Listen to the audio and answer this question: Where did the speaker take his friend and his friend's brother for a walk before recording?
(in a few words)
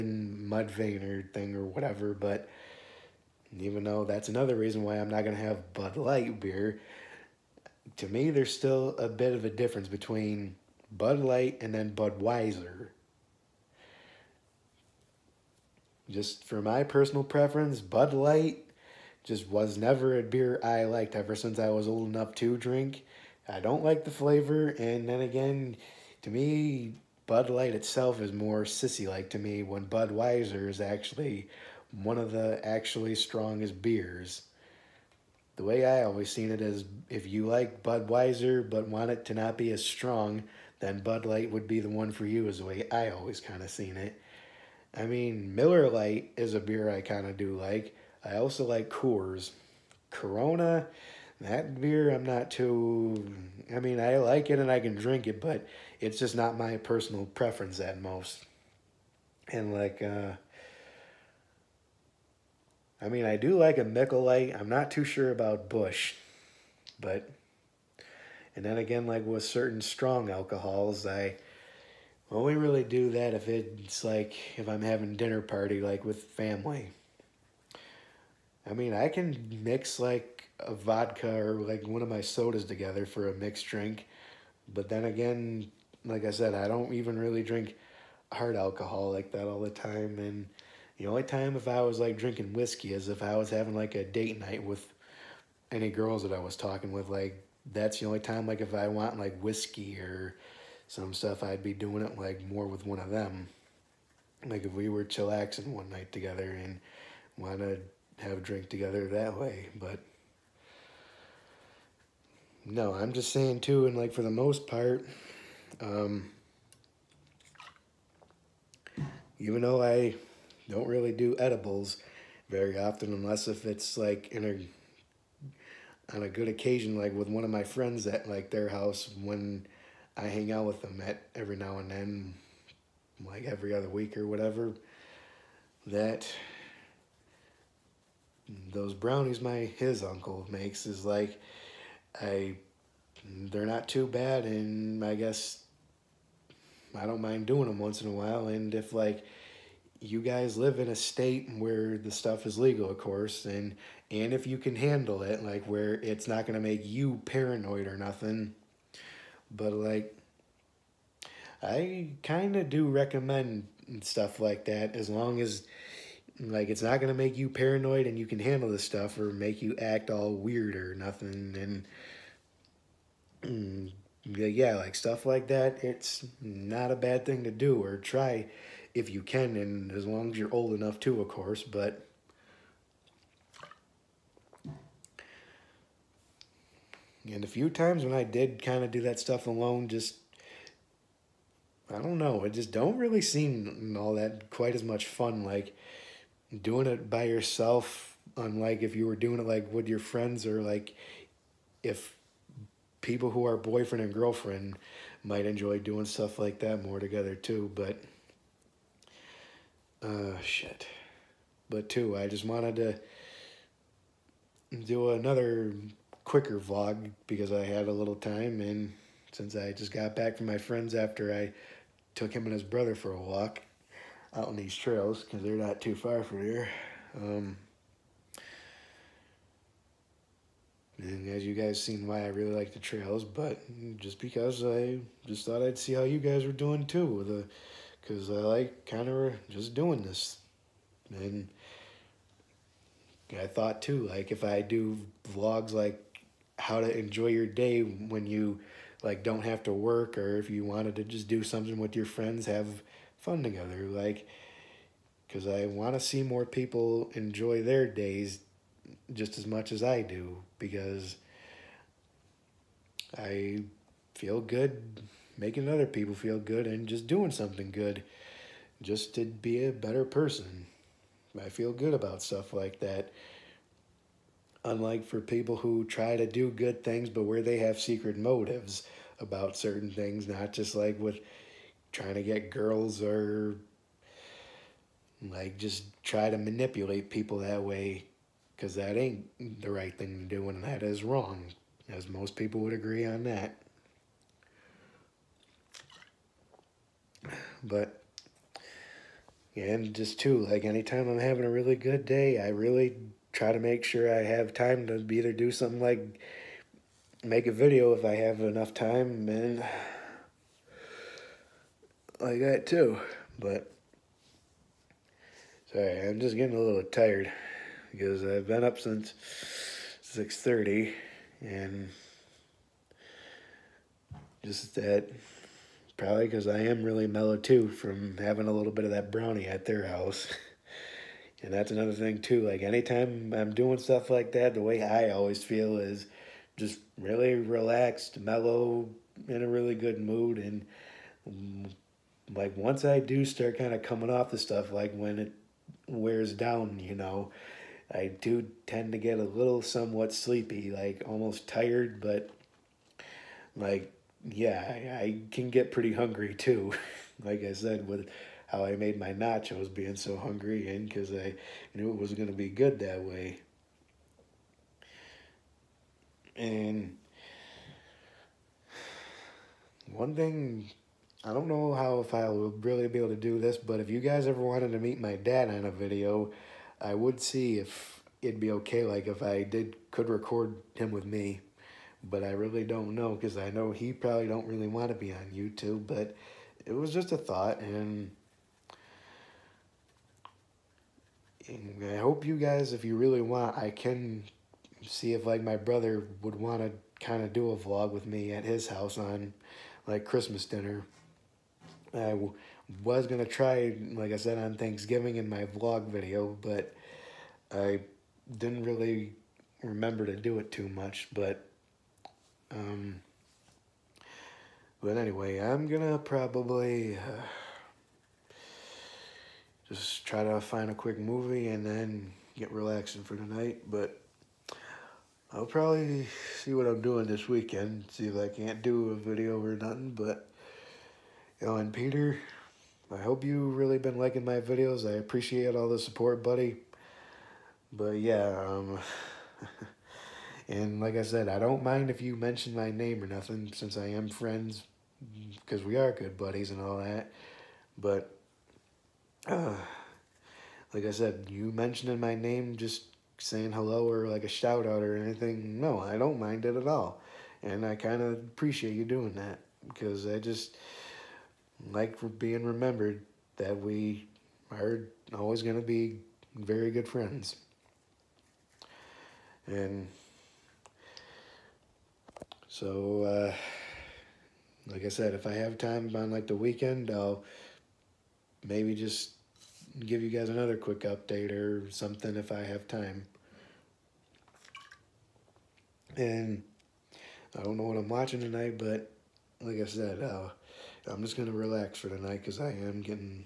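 the trails.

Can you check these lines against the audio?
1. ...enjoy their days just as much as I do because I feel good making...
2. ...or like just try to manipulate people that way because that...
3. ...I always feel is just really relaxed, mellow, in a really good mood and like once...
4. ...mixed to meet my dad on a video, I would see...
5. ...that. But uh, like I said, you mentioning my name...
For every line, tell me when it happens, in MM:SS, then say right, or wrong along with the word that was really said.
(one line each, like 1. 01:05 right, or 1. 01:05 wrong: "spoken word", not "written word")
1. 04:17 right
2. 04:43 right
3. 05:34 right
4. 06:14 wrong: "wanted", not "mixed"
5. 07:26 right.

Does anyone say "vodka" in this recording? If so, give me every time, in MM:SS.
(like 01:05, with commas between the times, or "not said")
01:20.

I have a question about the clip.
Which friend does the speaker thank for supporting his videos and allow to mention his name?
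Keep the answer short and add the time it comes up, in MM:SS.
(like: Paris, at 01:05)
Peter, at 07:11.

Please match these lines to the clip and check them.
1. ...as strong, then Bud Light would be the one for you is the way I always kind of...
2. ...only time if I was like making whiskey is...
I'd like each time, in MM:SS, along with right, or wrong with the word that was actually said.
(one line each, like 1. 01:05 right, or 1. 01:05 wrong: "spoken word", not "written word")
1. 00:39 right
2. 01:31 wrong: "drinking", not "making".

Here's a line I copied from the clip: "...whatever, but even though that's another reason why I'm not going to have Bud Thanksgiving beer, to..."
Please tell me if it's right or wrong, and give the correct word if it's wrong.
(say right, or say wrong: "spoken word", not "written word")
wrong: "Light", not "Thanksgiving".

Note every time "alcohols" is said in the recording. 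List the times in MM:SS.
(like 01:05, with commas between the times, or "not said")
01:10, 01:28.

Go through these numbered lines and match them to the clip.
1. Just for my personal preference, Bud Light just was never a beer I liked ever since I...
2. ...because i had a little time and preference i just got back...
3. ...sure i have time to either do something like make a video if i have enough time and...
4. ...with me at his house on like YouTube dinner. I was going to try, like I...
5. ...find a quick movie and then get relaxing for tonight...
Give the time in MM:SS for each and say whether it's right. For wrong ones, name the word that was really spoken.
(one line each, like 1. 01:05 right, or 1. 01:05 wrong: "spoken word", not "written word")
1. 00:16 right
2. 03:37 wrong: "since", not "preference"
3. 05:03 right
4. 06:37 wrong: "Christmas", not "YouTube"
5. 07:00 right.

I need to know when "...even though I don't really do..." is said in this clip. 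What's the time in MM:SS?
01:59.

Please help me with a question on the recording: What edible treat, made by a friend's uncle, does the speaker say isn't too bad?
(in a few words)
brownies.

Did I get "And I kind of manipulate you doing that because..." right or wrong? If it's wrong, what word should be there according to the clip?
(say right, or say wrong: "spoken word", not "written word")
wrong: "appreciate", not "manipulate".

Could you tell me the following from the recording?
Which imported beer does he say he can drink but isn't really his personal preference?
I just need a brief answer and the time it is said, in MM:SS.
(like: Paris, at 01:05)
Corona, at 00:50.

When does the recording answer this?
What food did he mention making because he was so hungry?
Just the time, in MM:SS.
05:59.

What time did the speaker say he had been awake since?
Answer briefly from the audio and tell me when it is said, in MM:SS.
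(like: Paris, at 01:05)
6:30, at 05:20.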